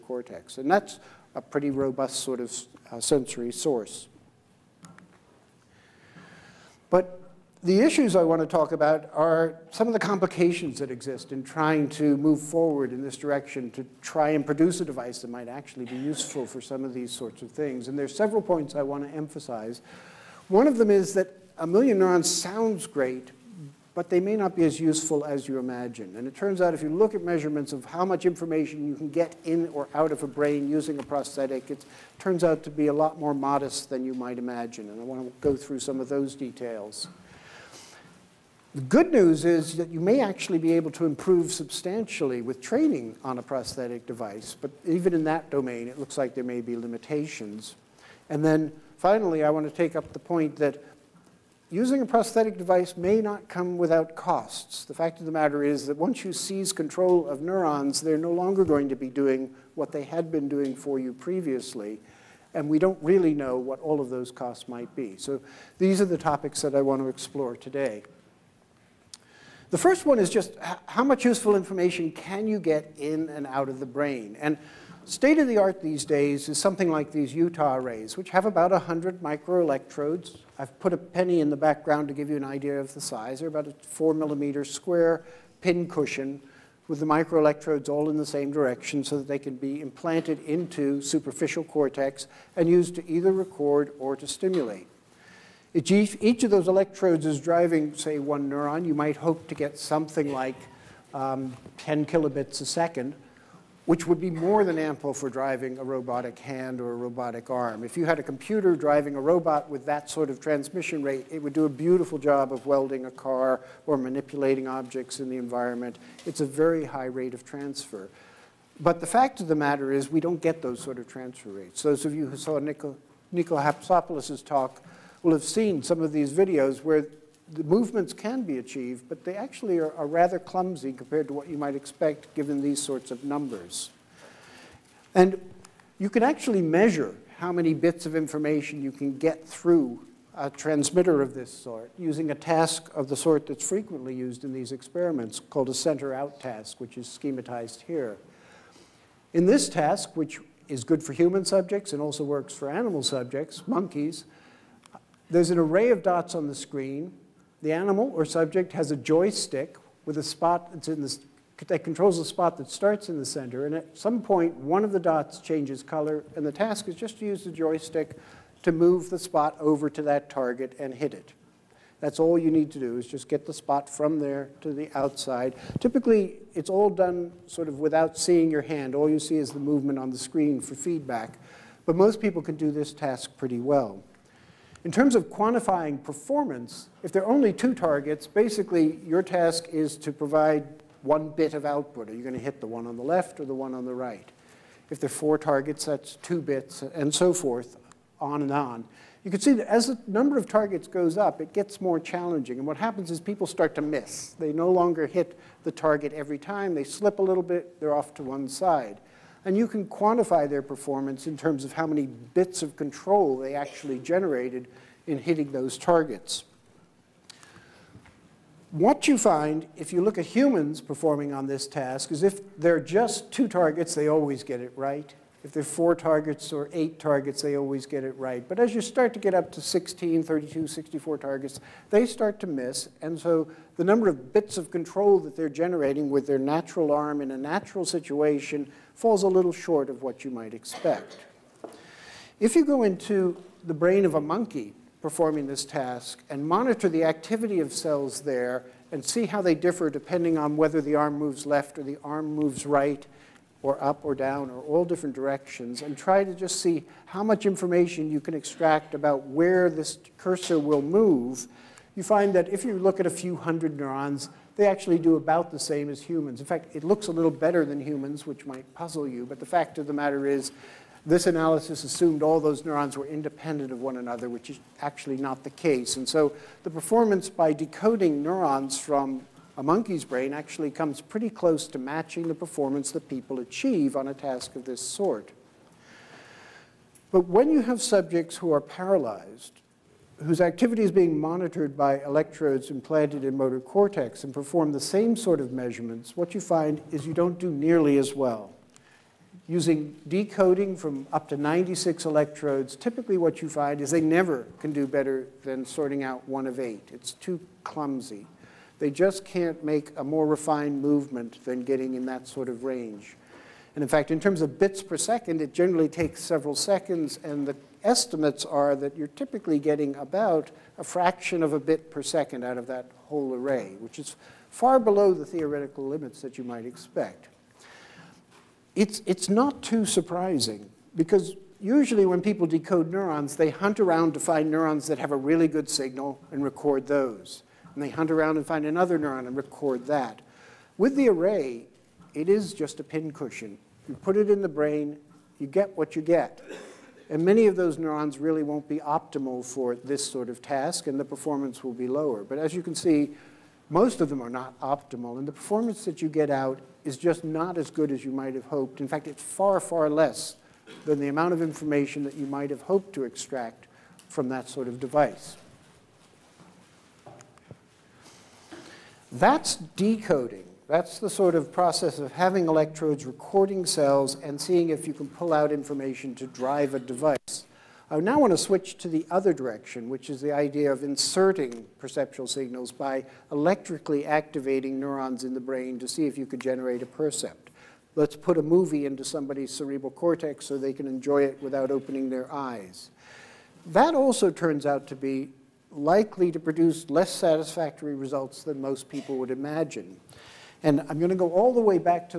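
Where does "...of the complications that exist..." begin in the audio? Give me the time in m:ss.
0:09.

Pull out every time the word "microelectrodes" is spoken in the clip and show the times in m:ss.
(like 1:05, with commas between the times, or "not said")
1:19, 1:27.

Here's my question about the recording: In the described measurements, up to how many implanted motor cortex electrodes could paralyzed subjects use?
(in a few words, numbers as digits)
96.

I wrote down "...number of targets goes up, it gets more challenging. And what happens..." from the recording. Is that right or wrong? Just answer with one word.
right.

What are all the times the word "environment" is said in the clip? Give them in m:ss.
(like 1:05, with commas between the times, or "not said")
1:55.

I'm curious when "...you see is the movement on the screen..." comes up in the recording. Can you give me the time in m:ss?
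2:59.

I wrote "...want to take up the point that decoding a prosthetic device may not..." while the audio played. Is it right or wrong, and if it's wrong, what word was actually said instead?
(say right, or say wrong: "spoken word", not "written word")
wrong: "using", not "decoding".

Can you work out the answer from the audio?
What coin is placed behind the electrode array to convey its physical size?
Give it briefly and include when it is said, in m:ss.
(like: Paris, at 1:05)
a penny, at 1:20.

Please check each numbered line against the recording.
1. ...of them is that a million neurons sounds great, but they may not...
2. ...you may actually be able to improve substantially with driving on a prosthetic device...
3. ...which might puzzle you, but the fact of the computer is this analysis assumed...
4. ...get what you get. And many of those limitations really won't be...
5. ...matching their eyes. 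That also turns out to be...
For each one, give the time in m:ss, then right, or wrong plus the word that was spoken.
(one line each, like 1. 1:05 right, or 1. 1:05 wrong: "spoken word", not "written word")
1. 0:20 right
2. 0:39 wrong: "training", not "driving"
3. 4:28 wrong: "matter", not "computer"
4. 5:45 wrong: "neurons", not "limitations"
5. 6:31 wrong: "opening", not "matching".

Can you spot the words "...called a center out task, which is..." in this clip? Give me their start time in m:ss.
2:25.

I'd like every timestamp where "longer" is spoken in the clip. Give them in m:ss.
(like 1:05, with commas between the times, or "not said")
0:58, 3:24.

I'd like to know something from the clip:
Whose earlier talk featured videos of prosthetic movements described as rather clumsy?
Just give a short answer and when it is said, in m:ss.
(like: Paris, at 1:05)
Nico Hatsopoulos, at 2:03.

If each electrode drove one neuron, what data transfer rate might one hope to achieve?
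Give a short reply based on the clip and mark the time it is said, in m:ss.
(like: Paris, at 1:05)
10 kilobits a second, at 1:41.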